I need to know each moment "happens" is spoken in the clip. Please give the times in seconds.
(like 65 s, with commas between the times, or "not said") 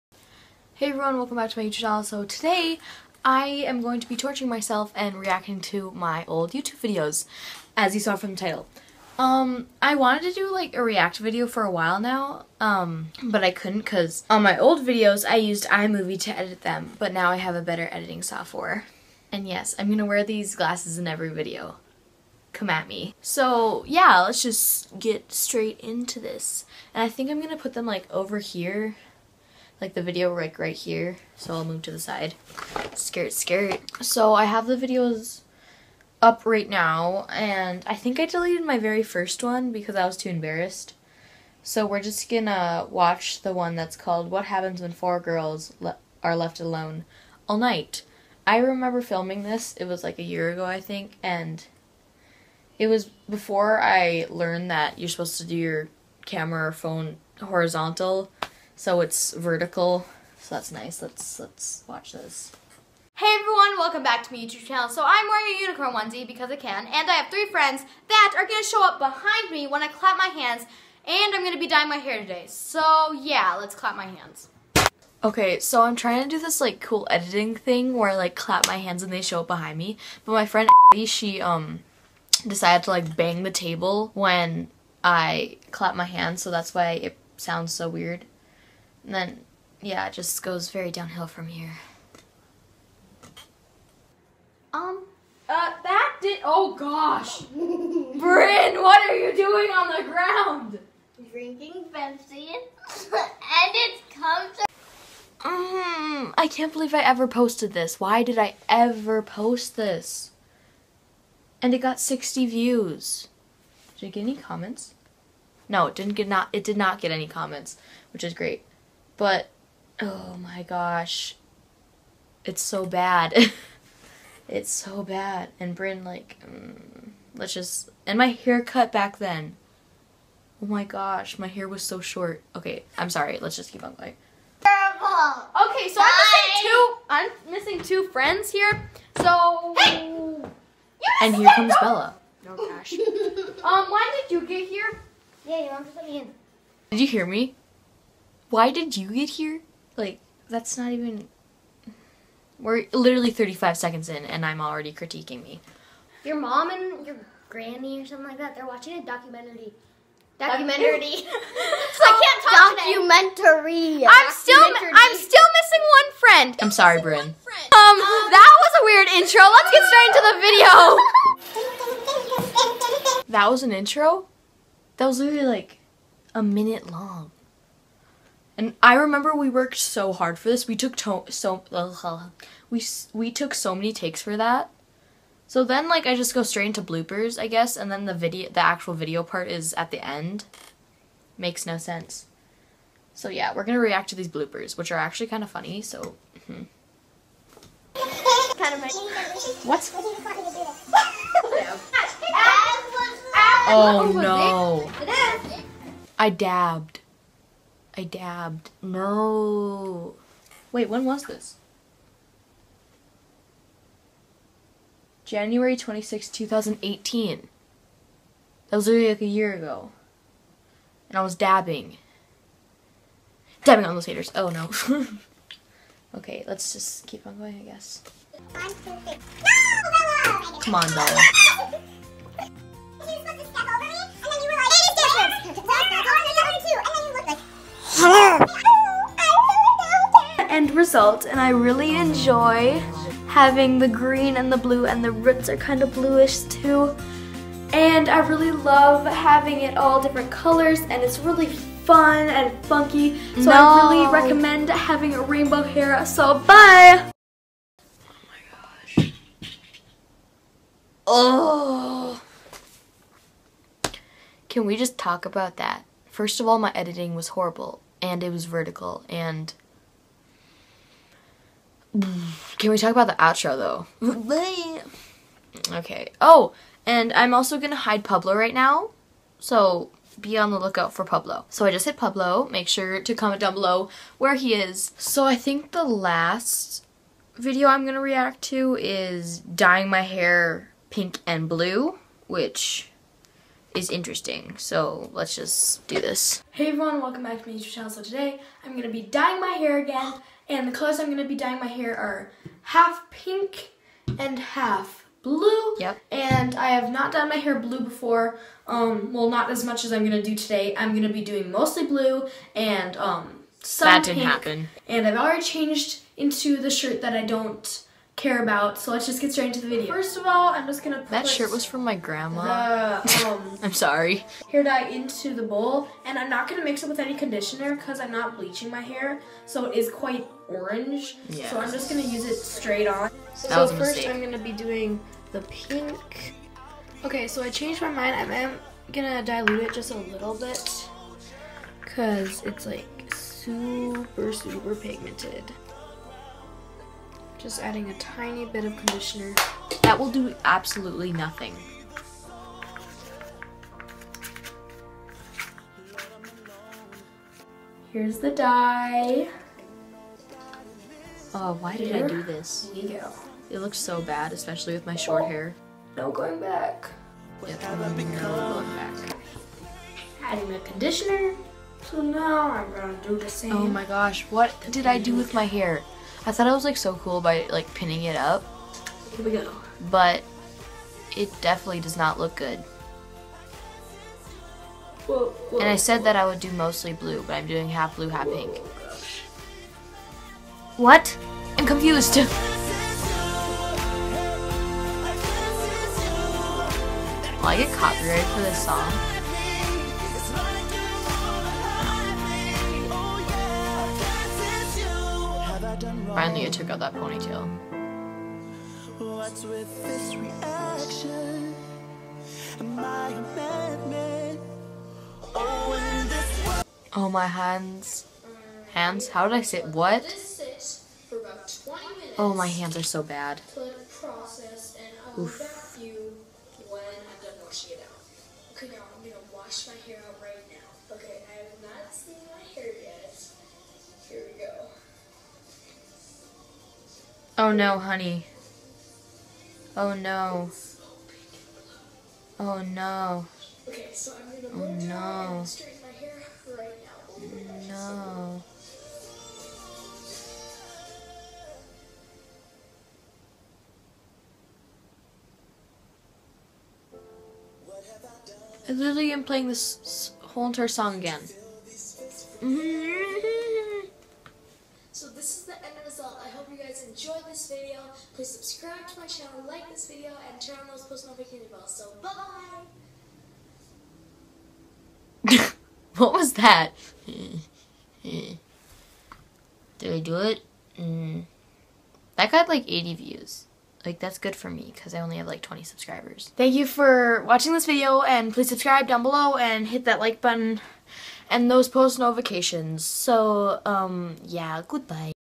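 44 s, 314 s.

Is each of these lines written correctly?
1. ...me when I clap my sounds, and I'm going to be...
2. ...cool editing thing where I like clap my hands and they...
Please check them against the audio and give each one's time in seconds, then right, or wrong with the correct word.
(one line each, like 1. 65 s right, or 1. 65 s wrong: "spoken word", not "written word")
1. 69 s wrong: "hands", not "sounds"
2. 76 s right.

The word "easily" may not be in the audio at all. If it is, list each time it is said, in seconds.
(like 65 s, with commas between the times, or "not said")
not said.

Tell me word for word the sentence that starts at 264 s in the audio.
Can we just talk about that?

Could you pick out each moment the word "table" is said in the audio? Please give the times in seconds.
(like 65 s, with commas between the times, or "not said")
83 s.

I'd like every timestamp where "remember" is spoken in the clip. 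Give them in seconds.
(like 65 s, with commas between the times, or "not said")
48 s, 178 s.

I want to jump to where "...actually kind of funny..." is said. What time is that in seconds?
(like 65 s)
194 s.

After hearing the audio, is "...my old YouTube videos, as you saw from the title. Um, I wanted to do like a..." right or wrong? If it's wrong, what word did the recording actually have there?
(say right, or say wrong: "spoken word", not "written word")
right.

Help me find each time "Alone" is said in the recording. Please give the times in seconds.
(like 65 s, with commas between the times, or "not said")
46 s.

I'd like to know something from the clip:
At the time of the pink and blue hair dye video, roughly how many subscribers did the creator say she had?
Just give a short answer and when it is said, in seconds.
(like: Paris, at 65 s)
20, at 485 s.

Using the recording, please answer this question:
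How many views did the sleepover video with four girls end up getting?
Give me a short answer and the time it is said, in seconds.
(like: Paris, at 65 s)
60, at 111 s.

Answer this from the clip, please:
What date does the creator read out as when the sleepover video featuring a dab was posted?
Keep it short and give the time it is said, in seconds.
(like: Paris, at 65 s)
January 26, 2018, at 215 s.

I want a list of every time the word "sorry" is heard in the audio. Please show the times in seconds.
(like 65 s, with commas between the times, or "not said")
133 s, 166 s, 323 s.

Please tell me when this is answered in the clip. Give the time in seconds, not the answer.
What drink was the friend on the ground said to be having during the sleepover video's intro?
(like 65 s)
101 s.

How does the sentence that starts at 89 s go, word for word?
And then, yeah, it just goes very downhill from here.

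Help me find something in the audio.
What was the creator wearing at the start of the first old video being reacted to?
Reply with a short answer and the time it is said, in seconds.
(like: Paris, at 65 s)
unicorn onesie, at 65 s.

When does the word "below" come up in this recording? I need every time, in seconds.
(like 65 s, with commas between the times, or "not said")
283 s, 489 s.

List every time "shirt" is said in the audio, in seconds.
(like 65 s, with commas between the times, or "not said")
316 s, 321 s.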